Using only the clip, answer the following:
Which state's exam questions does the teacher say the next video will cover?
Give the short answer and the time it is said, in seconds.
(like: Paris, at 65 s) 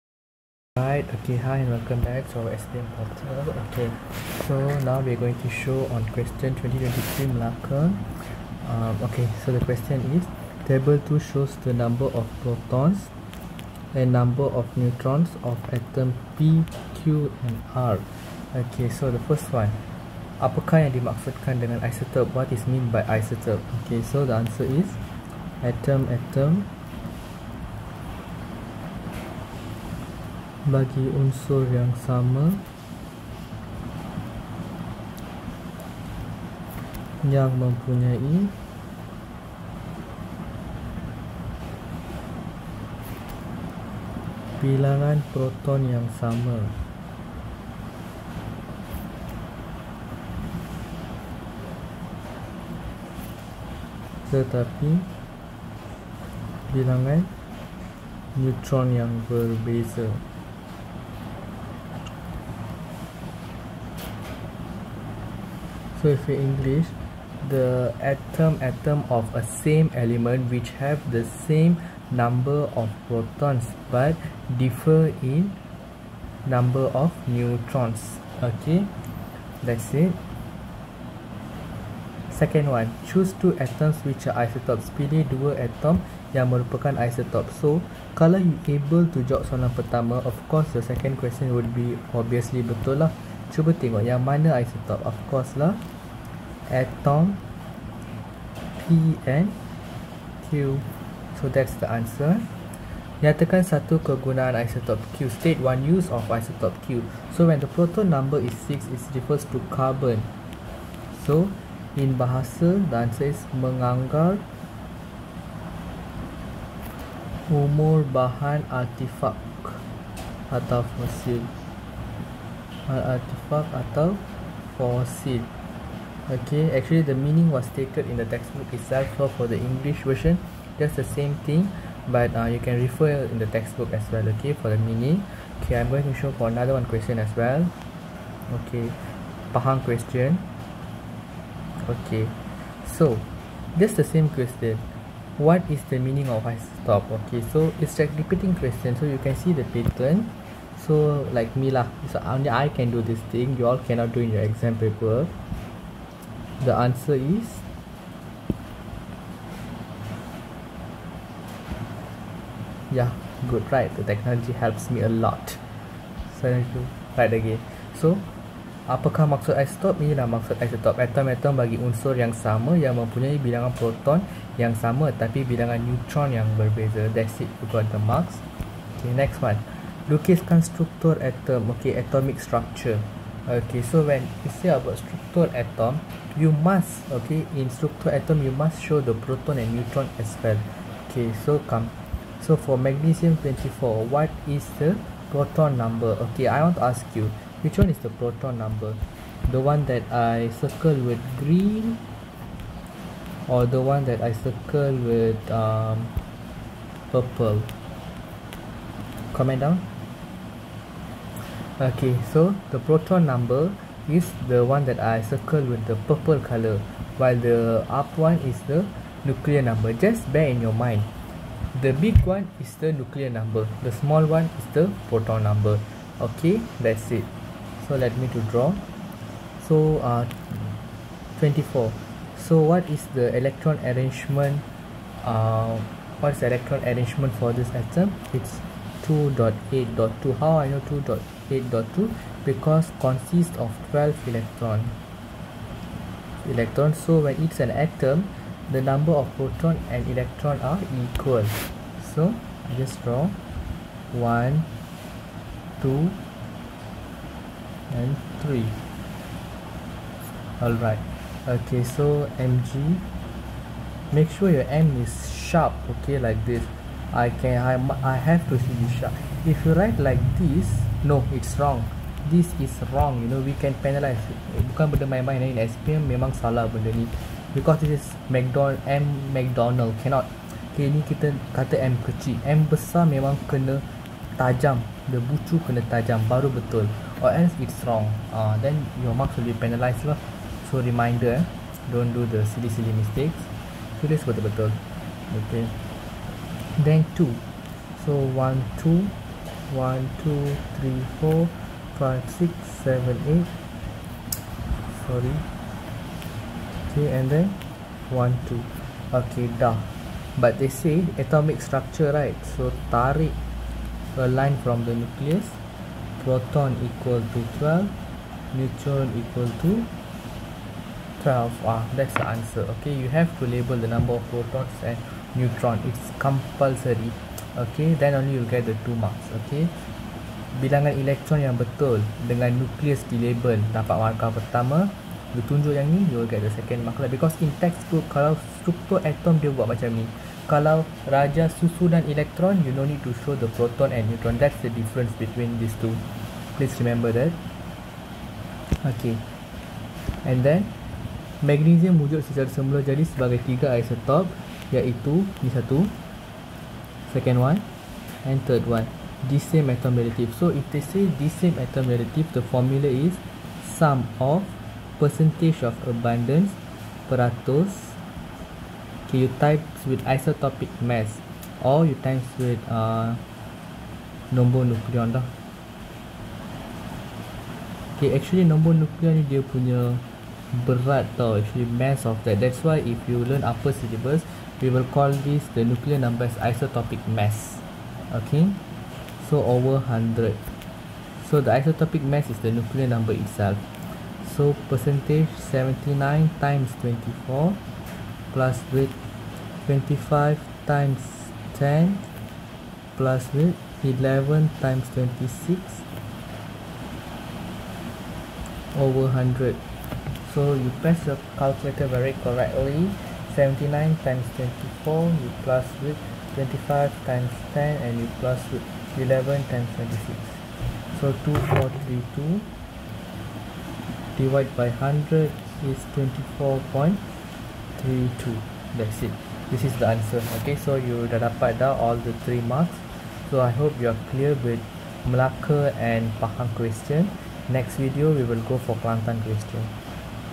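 Kelantan, at 438 s.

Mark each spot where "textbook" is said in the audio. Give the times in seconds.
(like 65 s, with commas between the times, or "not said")
128 s, 133 s, 337 s.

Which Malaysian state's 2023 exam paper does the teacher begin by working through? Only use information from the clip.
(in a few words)
Malacca.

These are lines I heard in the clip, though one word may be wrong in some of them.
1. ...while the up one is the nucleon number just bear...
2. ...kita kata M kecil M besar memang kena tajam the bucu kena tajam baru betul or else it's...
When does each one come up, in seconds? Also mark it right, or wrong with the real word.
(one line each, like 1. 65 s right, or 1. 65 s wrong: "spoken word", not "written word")
1. 217 s right
2. 281 s right.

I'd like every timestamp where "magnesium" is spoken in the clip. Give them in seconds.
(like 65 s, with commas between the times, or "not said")
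192 s, 351 s.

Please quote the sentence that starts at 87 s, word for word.
So, kalau you able to jawab soalan pertama, of course the second question would be obviously betul lah.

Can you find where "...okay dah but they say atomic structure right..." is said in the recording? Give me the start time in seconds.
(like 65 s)
309 s.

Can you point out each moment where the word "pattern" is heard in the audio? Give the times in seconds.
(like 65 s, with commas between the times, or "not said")
149 s.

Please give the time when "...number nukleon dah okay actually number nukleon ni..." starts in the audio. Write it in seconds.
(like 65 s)
374 s.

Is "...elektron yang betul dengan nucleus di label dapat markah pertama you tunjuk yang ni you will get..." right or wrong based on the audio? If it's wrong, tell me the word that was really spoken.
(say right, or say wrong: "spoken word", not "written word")
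wrong: "nukleus", not "nucleus".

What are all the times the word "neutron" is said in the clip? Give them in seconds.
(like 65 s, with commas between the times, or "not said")
14 s, 58 s, 77 s, 175 s, 189 s, 318 s, 325 s, 344 s.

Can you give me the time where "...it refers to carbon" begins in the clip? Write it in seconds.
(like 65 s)
108 s.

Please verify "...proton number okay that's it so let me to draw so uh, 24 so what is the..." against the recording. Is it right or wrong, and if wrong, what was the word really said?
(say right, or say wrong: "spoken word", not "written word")
right.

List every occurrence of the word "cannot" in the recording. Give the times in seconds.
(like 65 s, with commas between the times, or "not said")
153 s, 280 s.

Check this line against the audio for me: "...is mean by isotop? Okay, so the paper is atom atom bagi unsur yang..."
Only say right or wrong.
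wrong.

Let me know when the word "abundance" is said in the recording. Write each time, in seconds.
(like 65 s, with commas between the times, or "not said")
365 s.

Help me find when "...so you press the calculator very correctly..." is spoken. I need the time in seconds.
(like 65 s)
410 s.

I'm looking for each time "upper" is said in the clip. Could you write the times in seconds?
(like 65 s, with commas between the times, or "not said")
383 s.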